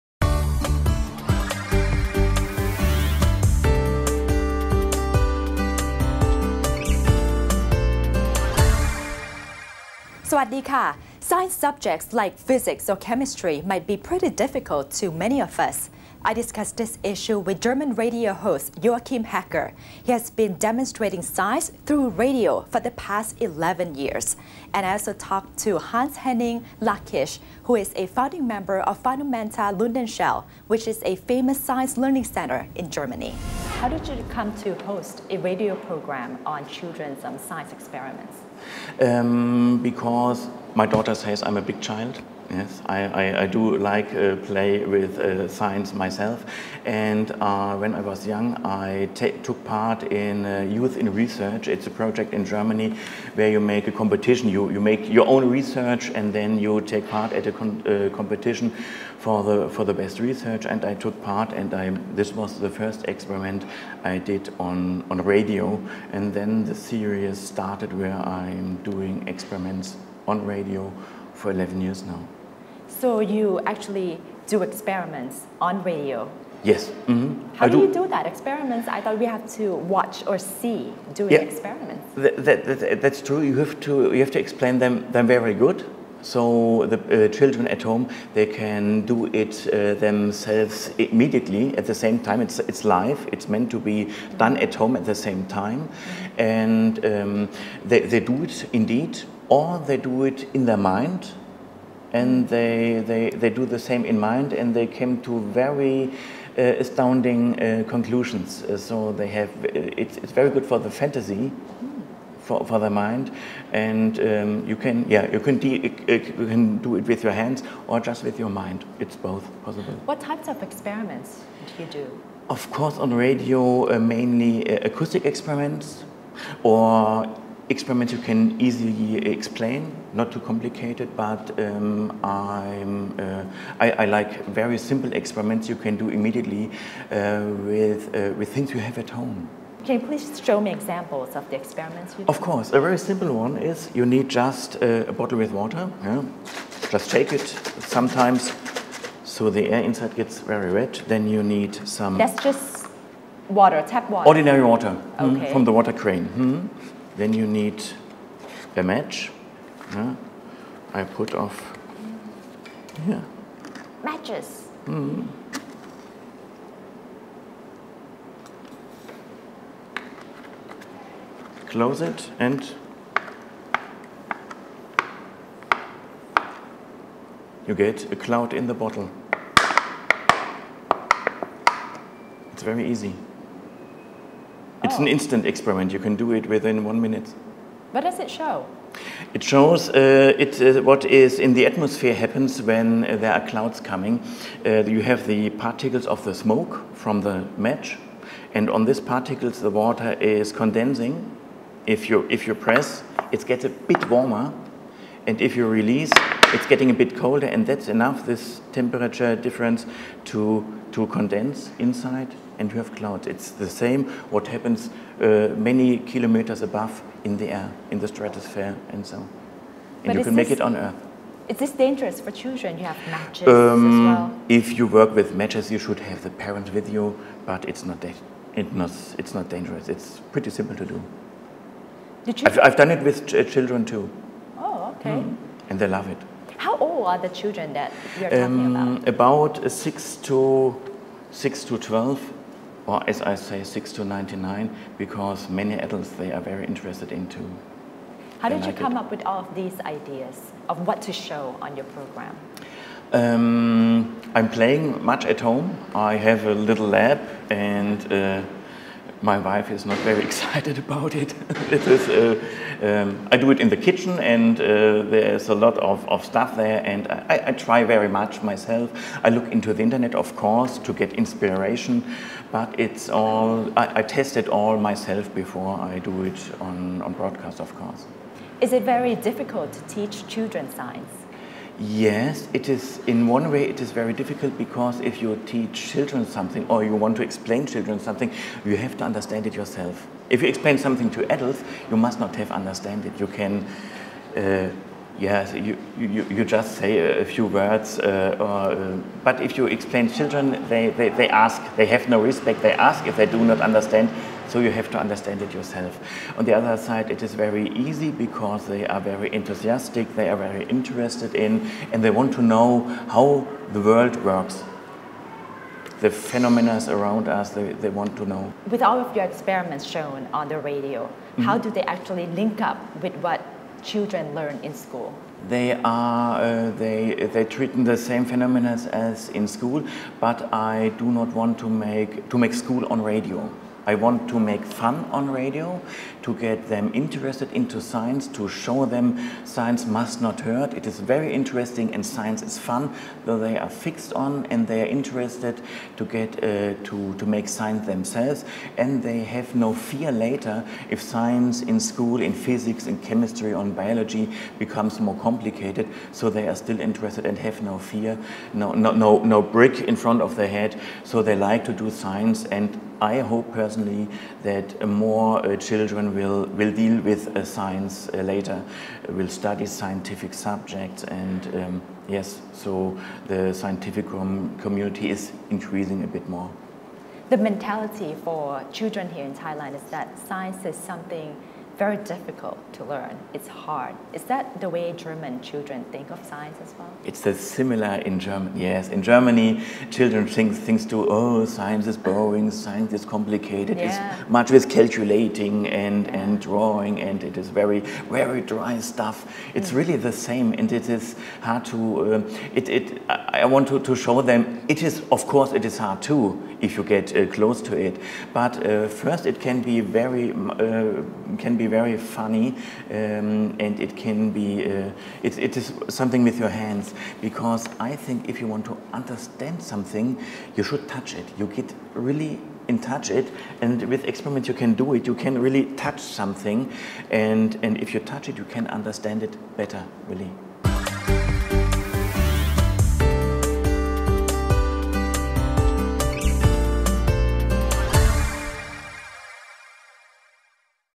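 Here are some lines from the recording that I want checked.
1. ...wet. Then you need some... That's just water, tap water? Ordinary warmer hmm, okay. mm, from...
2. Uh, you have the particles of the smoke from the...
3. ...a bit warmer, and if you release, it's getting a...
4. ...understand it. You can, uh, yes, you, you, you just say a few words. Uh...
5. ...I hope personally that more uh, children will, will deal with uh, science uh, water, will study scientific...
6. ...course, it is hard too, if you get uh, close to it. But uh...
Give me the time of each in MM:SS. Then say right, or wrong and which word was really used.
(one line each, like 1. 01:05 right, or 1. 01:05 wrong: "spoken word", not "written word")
1. 02:30 wrong: "water", not "warmer"
2. 03:14 right
3. 03:23 right
4. 04:52 right
5. 06:03 wrong: "later", not "water"
6. 06:45 right.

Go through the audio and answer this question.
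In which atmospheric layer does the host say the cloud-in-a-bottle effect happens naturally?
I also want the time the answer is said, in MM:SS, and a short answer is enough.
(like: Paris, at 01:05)
Stratosphere, at 03:38.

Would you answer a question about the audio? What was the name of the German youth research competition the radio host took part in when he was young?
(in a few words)
Youth in Research.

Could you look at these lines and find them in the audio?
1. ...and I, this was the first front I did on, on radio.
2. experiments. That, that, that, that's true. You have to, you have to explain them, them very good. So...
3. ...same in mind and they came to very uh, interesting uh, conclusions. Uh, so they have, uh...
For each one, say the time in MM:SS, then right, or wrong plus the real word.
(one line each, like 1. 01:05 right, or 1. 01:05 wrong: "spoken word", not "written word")
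1. 01:01 wrong: "experiment", not "front"
2. 01:21 right
3. 01:43 wrong: "astounding", not "interesting".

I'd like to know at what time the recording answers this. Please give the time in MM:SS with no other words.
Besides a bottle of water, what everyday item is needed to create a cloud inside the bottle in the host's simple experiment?
02:38.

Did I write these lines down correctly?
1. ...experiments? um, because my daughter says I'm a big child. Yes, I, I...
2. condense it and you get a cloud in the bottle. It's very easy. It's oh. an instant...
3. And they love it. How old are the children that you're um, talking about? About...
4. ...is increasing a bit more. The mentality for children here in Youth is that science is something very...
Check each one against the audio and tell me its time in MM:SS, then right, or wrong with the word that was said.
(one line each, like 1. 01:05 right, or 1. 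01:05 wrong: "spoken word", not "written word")
1. 00:37 right
2. 02:51 wrong: "close", not "condense"
3. 03:55 right
4. 06:15 wrong: "Thailand", not "Youth".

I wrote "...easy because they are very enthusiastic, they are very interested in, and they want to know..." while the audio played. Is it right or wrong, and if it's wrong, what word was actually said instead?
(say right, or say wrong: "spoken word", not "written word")
right.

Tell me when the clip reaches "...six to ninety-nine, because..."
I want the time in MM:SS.
04:03.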